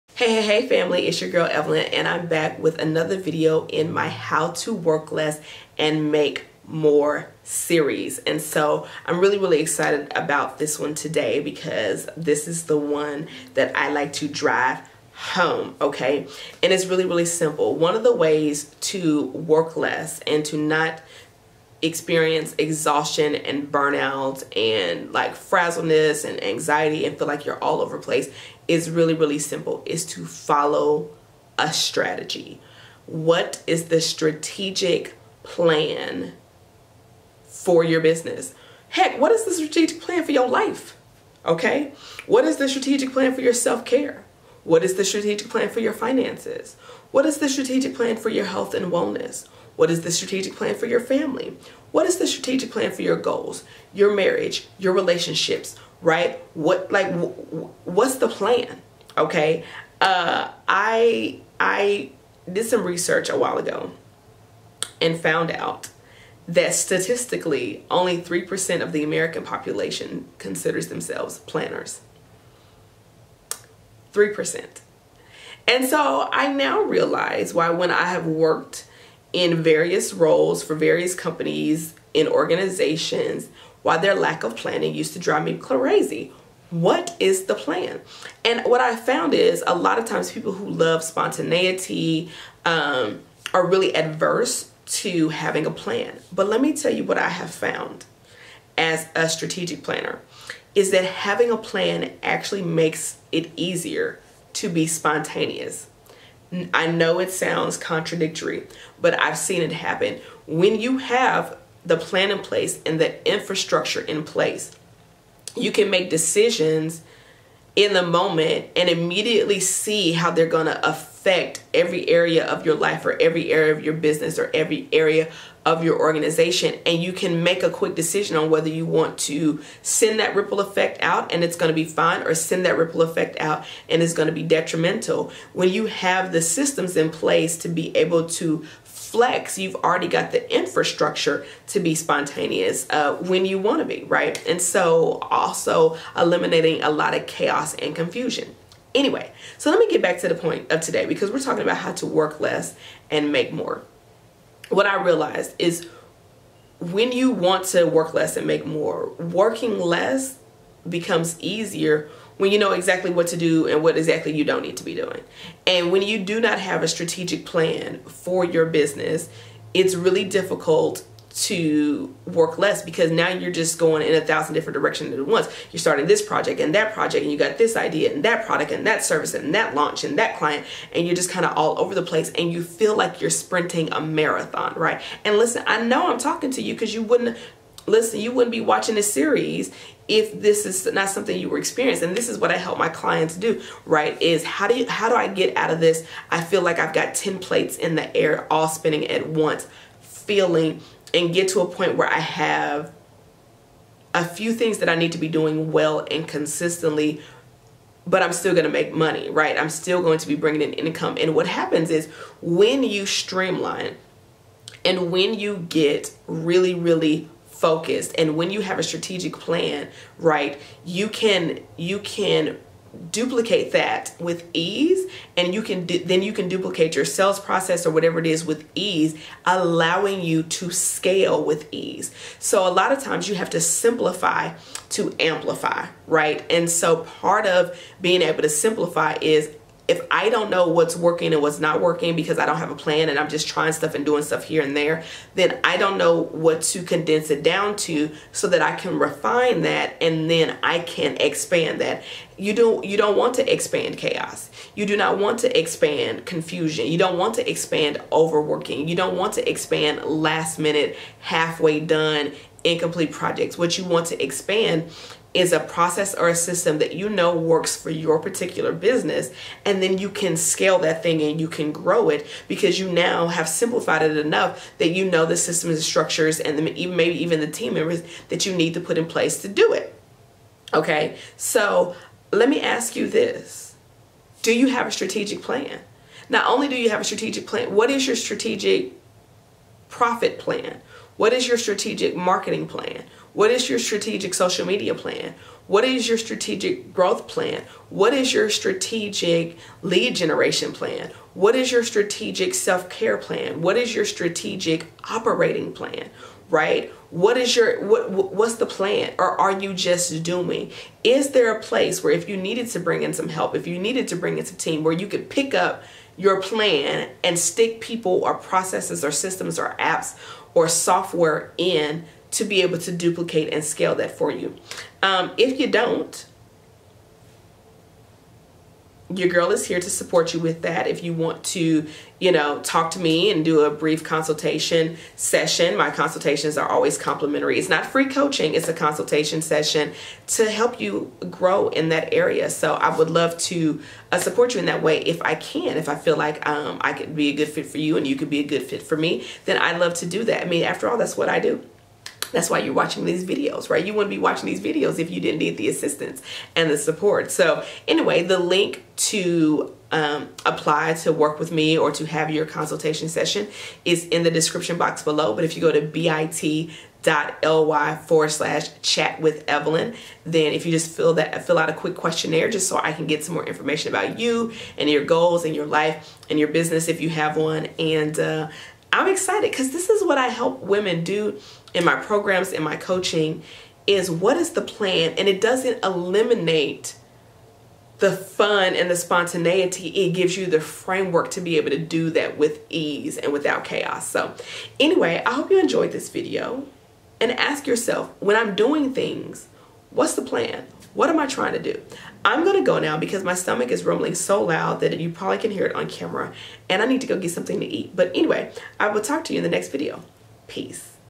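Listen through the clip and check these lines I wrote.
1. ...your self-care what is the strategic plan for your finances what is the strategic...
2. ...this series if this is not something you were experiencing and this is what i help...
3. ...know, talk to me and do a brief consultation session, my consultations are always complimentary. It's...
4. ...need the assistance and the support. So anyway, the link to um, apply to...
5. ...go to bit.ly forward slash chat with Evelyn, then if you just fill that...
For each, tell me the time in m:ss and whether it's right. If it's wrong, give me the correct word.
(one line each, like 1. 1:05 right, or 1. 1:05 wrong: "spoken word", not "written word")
1. 0:43 right
2. 3:08 right
3. 5:32 right
4. 5:55 right
5. 6:05 right.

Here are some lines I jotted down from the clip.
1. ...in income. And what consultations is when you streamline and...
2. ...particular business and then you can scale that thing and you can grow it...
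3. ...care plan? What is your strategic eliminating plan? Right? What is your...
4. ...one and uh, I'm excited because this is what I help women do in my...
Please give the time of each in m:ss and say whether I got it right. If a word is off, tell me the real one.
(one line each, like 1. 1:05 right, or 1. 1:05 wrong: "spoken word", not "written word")
1. 3:30 wrong: "happens", not "consultations"
2. 4:28 right
3. 5:02 wrong: "operating", not "eliminating"
4. 6:17 right.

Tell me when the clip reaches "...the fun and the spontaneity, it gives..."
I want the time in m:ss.
6:27.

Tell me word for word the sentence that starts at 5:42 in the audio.
So I would love to uh, support you in that way if I can.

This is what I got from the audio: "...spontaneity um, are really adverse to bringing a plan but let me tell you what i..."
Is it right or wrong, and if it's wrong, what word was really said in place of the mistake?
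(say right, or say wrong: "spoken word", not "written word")
wrong: "having", not "bringing".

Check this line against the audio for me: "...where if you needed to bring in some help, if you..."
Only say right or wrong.
right.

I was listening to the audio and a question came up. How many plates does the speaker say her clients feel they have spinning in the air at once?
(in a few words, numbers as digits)
10.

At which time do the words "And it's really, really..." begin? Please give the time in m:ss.
0:16.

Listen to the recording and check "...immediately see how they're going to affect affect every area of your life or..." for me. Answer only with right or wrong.
right.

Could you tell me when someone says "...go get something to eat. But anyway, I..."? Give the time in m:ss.
6:47.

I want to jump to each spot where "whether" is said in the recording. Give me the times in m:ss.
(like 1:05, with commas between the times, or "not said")
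2:08.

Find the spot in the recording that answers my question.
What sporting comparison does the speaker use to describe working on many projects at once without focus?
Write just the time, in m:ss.
3:03.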